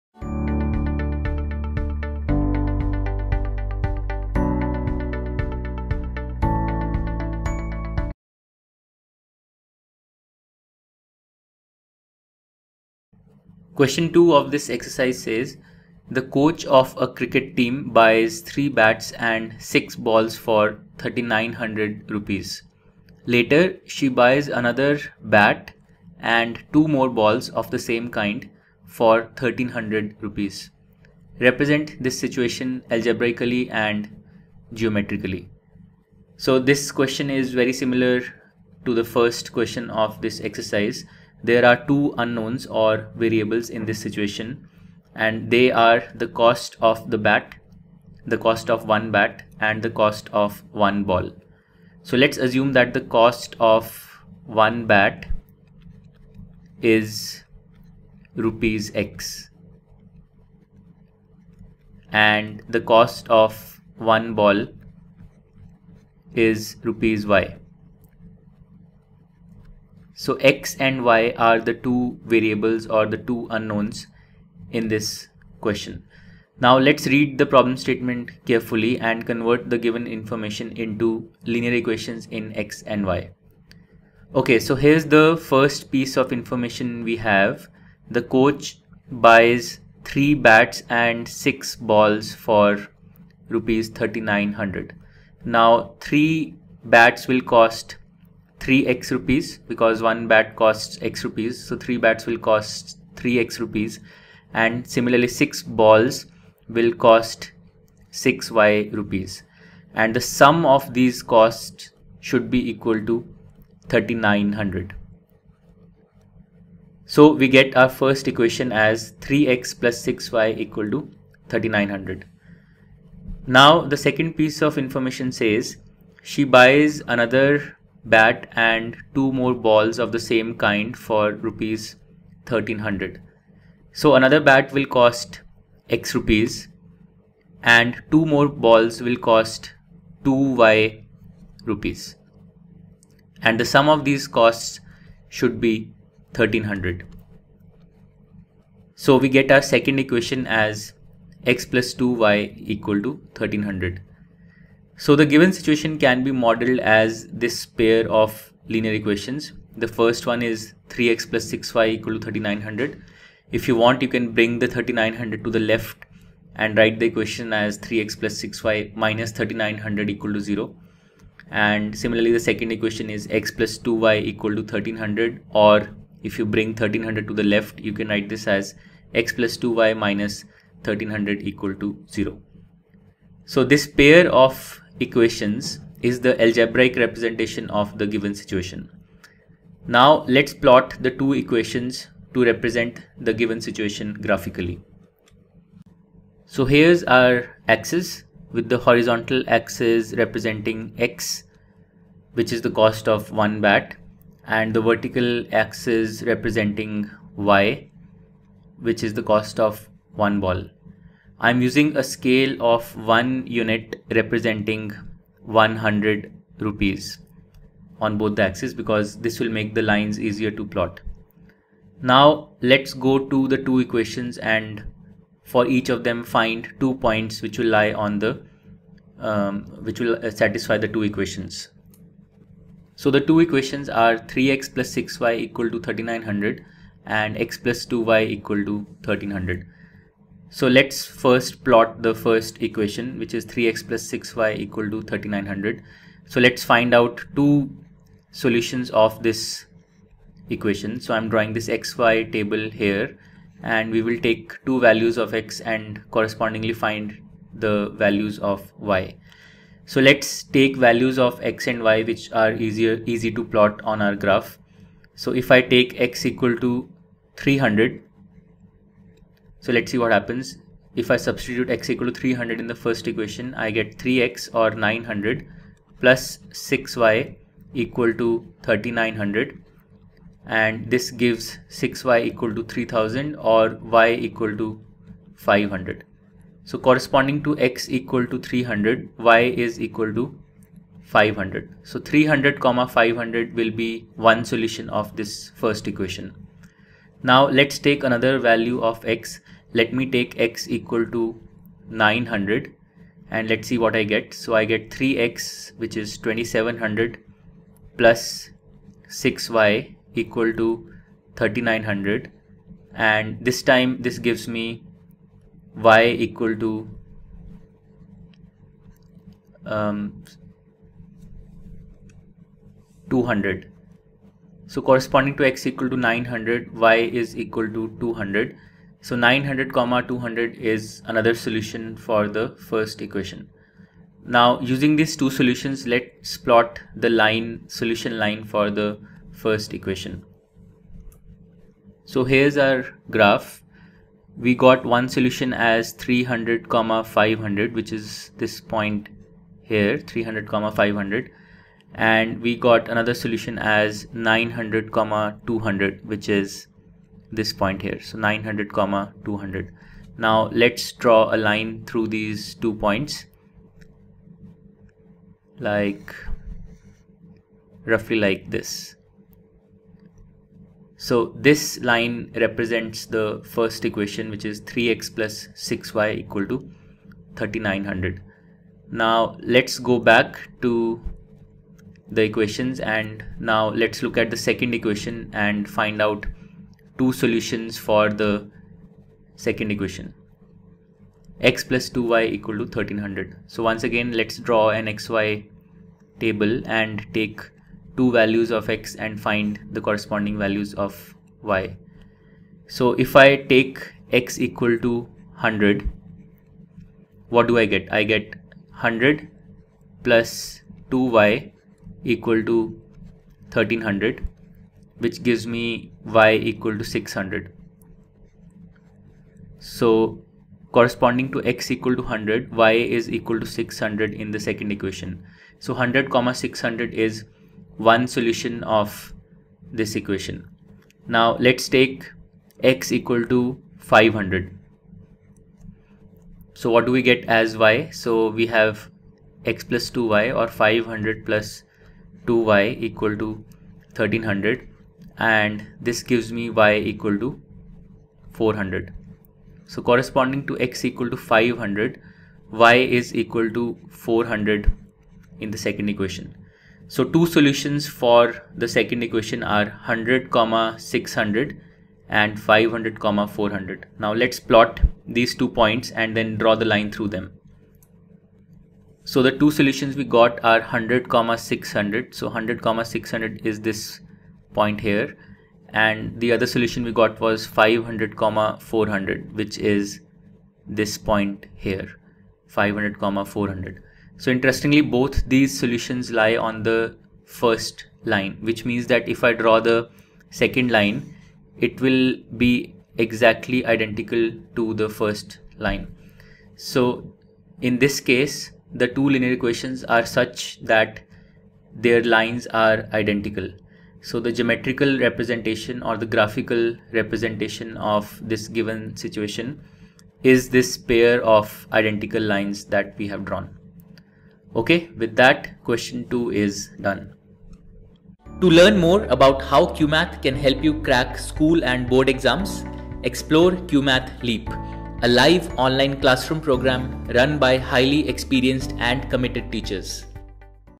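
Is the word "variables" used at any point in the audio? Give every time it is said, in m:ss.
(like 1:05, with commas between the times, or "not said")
0:43, 1:12.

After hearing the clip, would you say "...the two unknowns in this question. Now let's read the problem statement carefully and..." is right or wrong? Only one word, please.
right.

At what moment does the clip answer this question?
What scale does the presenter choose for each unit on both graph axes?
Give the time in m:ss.
3:35.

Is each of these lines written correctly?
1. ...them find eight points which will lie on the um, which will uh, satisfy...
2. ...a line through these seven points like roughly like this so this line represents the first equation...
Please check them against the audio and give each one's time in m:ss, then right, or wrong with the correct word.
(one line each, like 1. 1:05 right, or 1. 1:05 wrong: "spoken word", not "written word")
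1. 3:46 wrong: "two", not "eight"
2. 6:01 wrong: "two", not "seven".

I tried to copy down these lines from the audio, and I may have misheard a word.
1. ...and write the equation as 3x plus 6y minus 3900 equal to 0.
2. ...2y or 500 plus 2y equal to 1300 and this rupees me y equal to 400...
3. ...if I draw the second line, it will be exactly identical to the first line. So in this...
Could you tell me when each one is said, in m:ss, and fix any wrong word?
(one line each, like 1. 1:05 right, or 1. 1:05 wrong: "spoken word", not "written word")
1. 2:46 right
2. 7:19 wrong: "gives", not "rupees"
3. 8:09 right.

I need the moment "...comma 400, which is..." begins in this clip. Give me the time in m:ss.
7:58.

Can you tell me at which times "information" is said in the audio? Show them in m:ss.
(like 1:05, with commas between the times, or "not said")
1:20, 1:26, 2:04.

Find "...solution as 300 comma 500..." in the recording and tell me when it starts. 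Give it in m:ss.
5:45.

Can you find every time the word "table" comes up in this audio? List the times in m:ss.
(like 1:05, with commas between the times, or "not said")
4:12, 6:36.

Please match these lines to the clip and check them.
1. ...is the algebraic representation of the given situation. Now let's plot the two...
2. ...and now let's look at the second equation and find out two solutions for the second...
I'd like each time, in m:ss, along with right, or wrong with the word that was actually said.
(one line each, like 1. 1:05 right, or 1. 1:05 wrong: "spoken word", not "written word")
1. 3:06 right
2. 6:22 right.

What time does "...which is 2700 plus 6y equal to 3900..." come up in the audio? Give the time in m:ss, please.
5:05.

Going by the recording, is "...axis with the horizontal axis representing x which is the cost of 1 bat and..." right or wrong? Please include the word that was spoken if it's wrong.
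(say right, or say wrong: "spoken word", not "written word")
right.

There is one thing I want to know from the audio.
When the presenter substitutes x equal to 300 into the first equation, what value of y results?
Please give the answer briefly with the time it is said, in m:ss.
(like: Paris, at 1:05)
500, at 4:43.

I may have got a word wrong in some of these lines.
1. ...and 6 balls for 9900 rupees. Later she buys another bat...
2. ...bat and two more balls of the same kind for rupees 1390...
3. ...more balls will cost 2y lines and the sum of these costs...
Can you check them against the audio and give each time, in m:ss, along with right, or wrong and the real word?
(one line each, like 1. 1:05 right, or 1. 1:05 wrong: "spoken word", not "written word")
1. 0:19 wrong: "3900", not "9900"
2. 2:08 wrong: "1300", not "1390"
3. 2:18 wrong: "rupees", not "lines".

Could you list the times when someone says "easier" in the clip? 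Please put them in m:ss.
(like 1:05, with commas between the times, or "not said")
3:40, 4:22.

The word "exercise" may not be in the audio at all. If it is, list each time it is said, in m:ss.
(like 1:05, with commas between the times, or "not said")
0:14, 0:40.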